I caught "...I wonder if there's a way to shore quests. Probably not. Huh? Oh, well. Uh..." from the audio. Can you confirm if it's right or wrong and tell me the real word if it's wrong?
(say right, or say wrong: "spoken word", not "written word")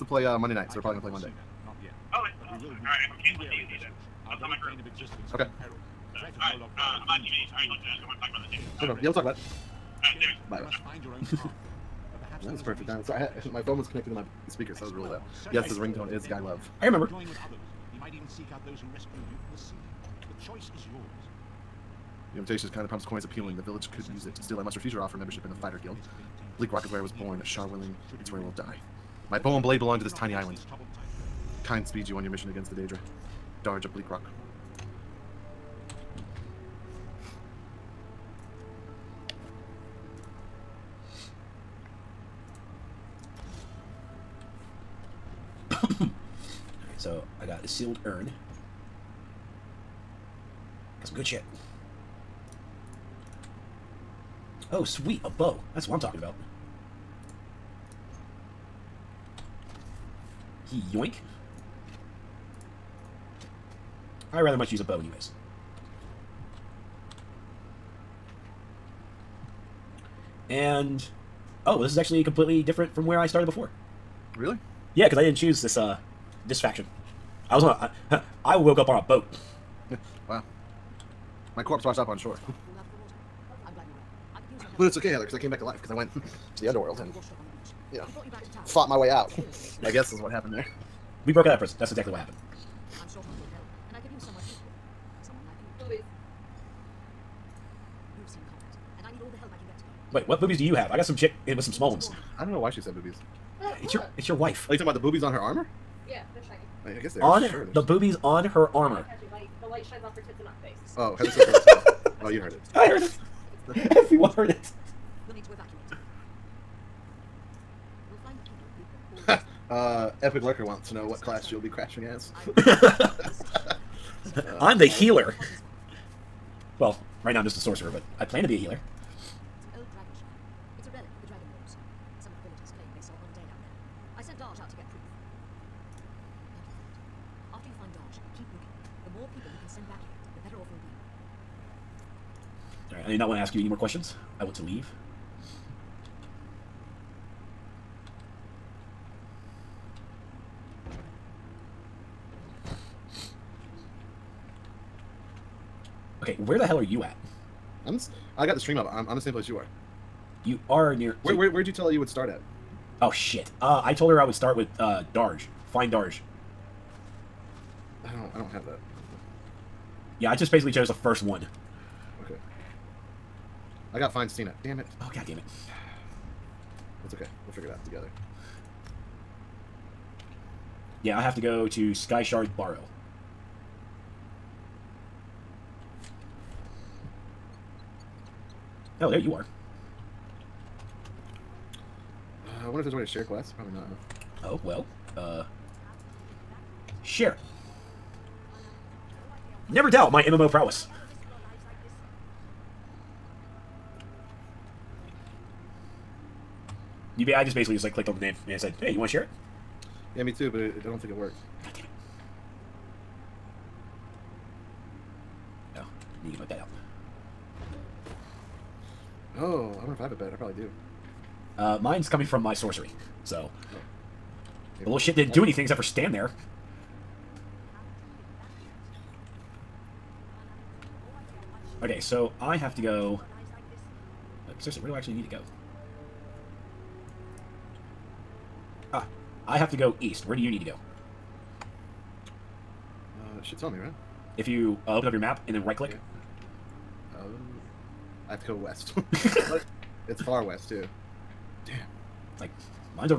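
wrong: "share", not "shore".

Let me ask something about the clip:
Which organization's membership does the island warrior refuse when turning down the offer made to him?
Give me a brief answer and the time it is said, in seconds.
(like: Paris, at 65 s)
Fighter Guild, at 25 s.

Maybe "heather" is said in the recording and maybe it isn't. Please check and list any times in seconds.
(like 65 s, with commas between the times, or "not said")
85 s, 111 s.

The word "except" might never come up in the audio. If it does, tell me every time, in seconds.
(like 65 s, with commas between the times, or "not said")
225 s.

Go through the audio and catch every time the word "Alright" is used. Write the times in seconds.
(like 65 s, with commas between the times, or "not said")
5 s, 9 s.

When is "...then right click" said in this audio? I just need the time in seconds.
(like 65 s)
245 s.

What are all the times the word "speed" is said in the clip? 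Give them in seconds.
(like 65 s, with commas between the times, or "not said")
31 s.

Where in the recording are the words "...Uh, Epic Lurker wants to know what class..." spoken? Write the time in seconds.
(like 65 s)
119 s.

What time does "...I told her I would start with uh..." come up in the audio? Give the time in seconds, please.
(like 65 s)
163 s.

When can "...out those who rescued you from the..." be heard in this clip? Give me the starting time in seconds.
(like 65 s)
18 s.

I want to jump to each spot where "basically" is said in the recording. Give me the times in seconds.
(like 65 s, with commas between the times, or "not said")
170 s, 207 s.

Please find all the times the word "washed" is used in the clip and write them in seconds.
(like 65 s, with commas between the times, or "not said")
81 s.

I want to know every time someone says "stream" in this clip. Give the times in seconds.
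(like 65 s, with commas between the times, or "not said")
158 s.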